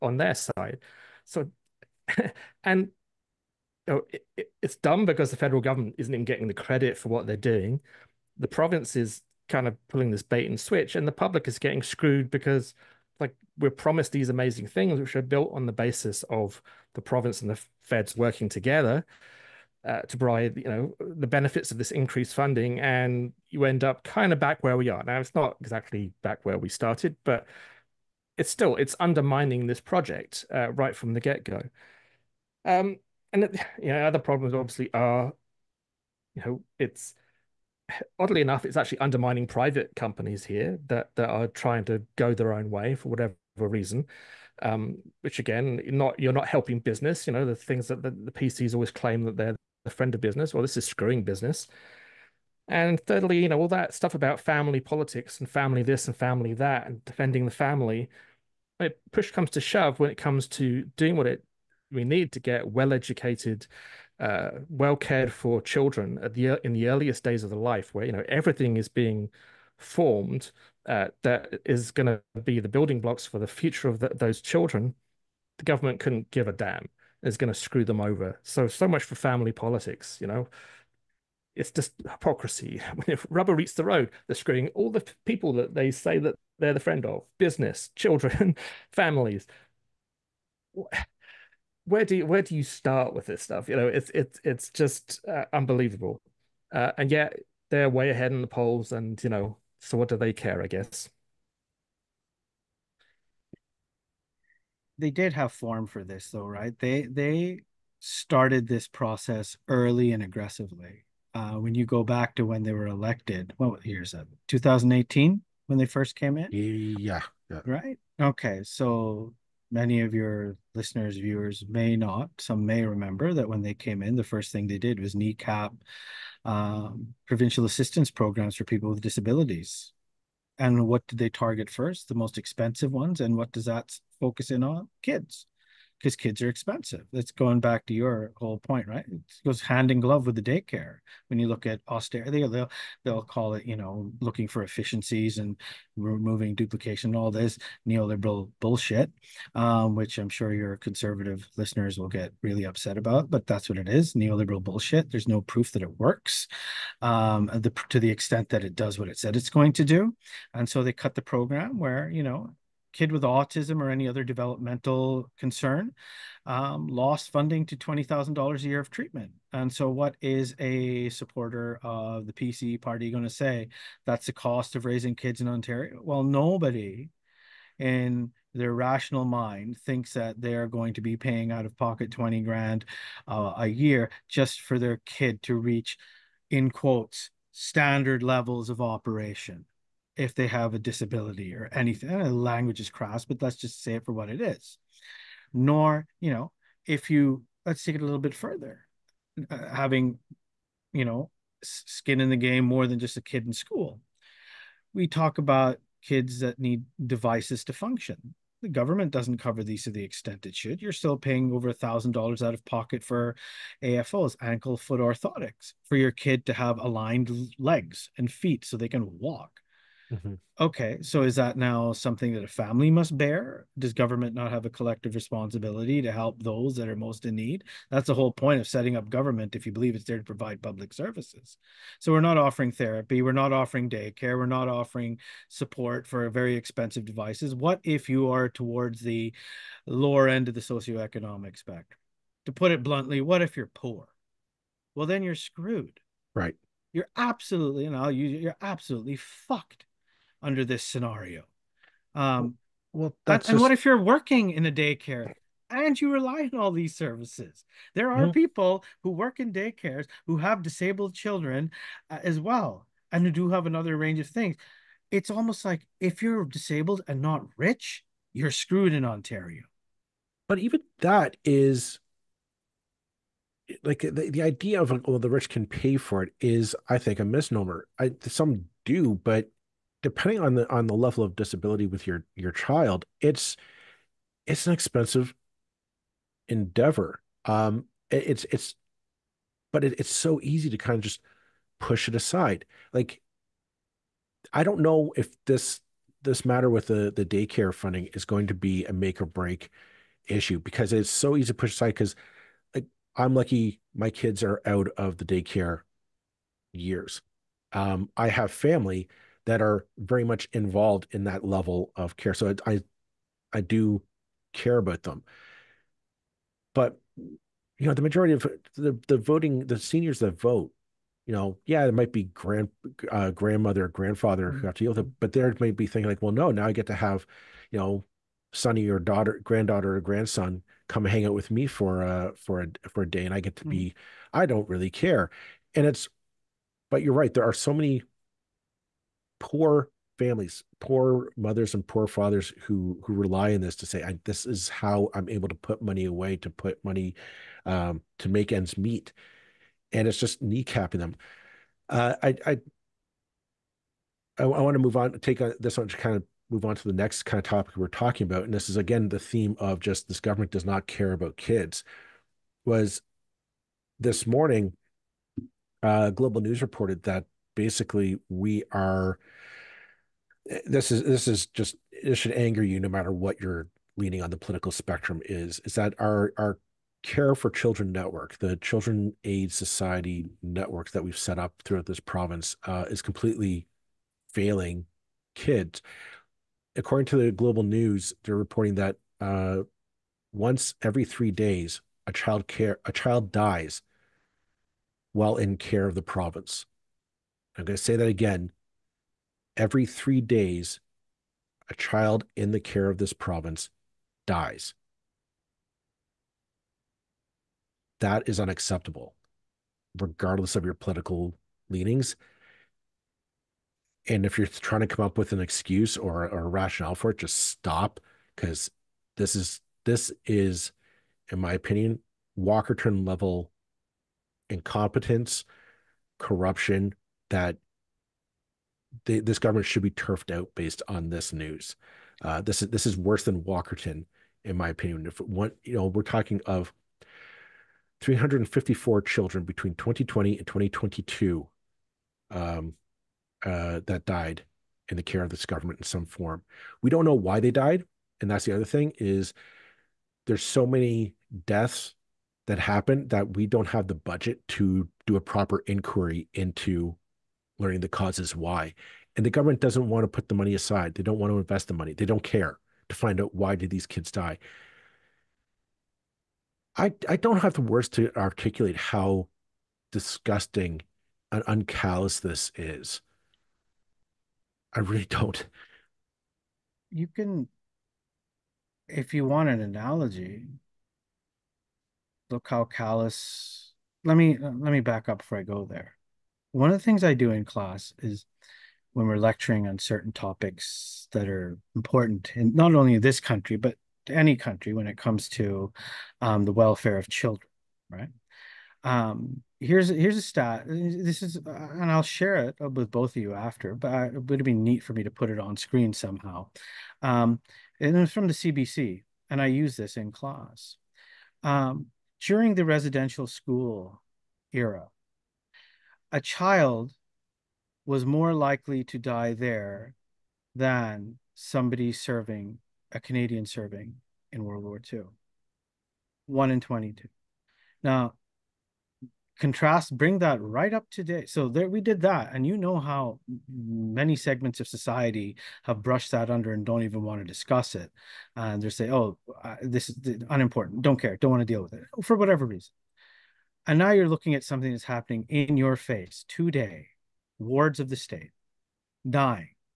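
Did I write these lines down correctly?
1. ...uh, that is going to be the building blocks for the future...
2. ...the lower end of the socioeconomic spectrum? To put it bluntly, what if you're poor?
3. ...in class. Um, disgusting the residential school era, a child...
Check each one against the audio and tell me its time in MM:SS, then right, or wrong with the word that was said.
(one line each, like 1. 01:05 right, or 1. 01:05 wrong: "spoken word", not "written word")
1. 01:10 right
2. 03:58 right
3. 08:29 wrong: "during", not "disgusting".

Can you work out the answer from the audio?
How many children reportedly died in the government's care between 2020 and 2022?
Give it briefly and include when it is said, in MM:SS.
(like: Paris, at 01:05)
354, at 07:18.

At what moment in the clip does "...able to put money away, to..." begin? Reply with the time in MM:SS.
05:45.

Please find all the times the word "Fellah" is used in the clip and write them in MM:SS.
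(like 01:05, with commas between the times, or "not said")
not said.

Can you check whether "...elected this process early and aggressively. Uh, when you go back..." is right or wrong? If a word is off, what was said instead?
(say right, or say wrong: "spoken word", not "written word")
wrong: "started", not "elected".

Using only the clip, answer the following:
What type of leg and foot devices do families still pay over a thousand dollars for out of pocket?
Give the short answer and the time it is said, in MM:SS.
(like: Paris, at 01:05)
AFOs (ankle foot orthotics), at 03:33.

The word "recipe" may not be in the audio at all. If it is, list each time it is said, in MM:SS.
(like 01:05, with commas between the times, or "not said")
not said.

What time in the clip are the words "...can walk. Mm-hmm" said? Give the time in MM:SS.
03:38.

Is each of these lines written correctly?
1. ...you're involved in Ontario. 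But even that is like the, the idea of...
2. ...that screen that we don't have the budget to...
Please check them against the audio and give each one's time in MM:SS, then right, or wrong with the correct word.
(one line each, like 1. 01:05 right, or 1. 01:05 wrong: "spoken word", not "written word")
1. 04:28 wrong: "screwed", not "involved"
2. 07:32 wrong: "happen", not "screen".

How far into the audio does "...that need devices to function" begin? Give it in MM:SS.
03:26.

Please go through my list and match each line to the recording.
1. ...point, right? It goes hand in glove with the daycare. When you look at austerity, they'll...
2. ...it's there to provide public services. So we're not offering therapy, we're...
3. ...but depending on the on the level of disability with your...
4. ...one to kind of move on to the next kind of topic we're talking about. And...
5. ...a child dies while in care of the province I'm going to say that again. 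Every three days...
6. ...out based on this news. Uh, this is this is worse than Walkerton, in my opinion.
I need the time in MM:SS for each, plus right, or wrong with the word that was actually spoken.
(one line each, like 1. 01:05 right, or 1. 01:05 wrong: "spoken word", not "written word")
1. 02:18 right
2. 03:49 right
3. 04:39 right
4. 05:55 right
5. 06:32 right
6. 07:10 right.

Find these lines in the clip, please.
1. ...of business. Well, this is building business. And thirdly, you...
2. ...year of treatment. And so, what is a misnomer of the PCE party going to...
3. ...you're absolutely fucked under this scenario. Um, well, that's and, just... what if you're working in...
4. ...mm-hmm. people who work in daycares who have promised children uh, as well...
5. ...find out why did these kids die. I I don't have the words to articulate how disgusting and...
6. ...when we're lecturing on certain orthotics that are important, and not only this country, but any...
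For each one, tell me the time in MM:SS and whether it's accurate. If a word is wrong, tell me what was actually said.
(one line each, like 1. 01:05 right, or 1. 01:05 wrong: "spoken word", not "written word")
1. 00:50 wrong: "screwing", not "building"
2. 02:48 wrong: "supporter", not "misnomer"
3. 04:08 right
4. 04:18 wrong: "disabled", not "promised"
5. 07:42 right
6. 08:08 wrong: "topics", not "orthotics".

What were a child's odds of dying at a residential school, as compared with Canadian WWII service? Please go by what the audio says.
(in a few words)
1 in 22.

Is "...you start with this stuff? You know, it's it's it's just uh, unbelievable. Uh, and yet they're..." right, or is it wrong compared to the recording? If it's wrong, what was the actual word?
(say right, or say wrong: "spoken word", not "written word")
right.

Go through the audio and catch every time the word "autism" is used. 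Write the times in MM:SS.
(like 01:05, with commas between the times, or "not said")
02:43.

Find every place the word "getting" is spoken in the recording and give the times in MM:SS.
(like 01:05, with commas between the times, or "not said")
00:06, 00:11.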